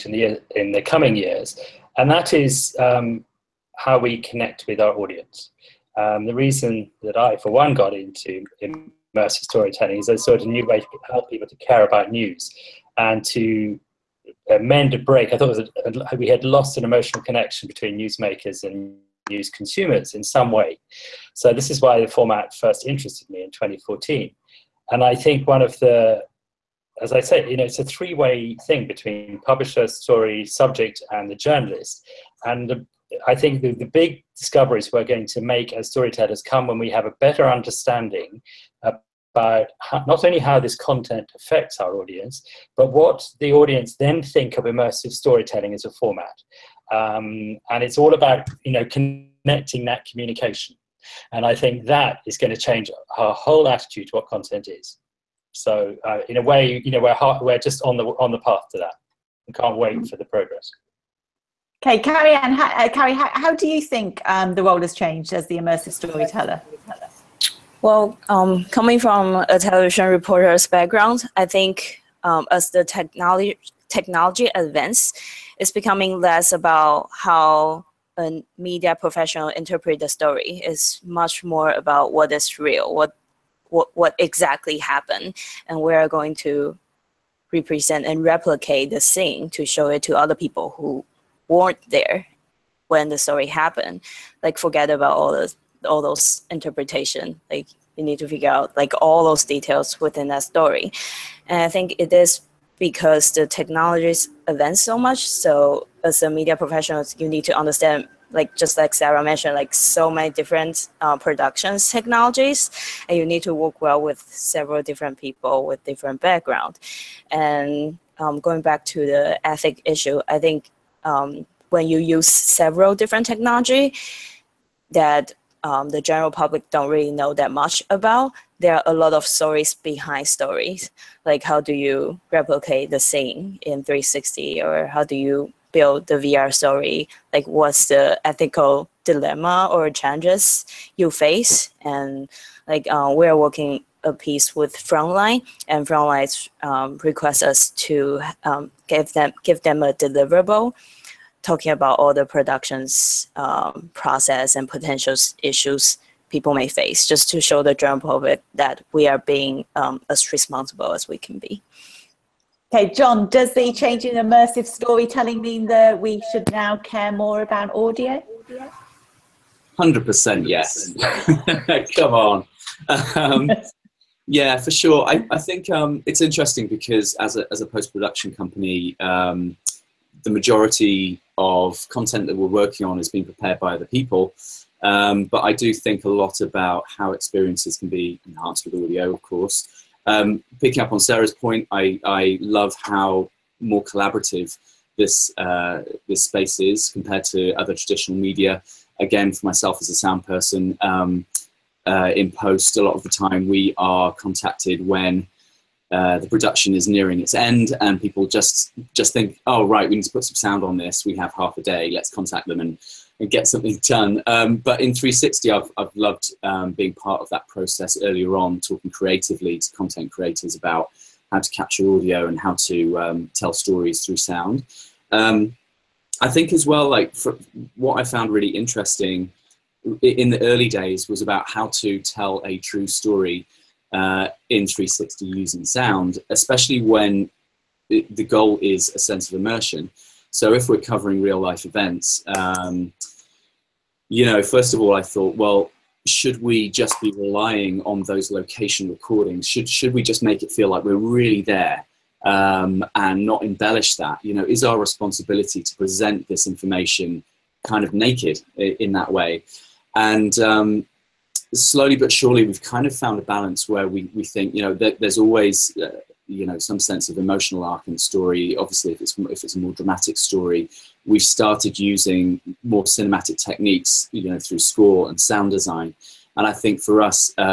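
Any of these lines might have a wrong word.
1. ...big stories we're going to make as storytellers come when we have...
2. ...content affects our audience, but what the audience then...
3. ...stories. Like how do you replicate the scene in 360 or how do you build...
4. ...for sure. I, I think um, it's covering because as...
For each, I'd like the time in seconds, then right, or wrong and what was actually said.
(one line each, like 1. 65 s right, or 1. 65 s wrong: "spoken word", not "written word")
1. 33 s wrong: "discoveries", not "stories"
2. 40 s right
3. 130 s right
4. 174 s wrong: "interesting", not "covering".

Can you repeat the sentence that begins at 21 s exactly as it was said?
So this is why the format first interested me in 2014.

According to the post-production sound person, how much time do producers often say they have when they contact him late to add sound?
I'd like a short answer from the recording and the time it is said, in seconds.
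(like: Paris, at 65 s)
Half a day, at 211 s.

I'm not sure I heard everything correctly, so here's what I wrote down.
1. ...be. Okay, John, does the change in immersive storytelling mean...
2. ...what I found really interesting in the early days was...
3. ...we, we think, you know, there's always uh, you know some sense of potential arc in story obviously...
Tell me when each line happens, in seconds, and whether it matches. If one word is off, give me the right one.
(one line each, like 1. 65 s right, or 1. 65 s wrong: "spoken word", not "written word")
1. 161 s right
2. 227 s right
3. 263 s wrong: "emotional", not "potential".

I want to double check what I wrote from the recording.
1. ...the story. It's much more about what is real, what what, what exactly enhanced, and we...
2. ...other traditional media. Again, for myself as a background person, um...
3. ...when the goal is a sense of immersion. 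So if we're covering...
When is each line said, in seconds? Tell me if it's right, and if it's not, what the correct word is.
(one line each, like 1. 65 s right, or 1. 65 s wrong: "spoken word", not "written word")
1. 79 s wrong: "happened", not "enhanced"
2. 197 s wrong: "sound", not "background"
3. 236 s right.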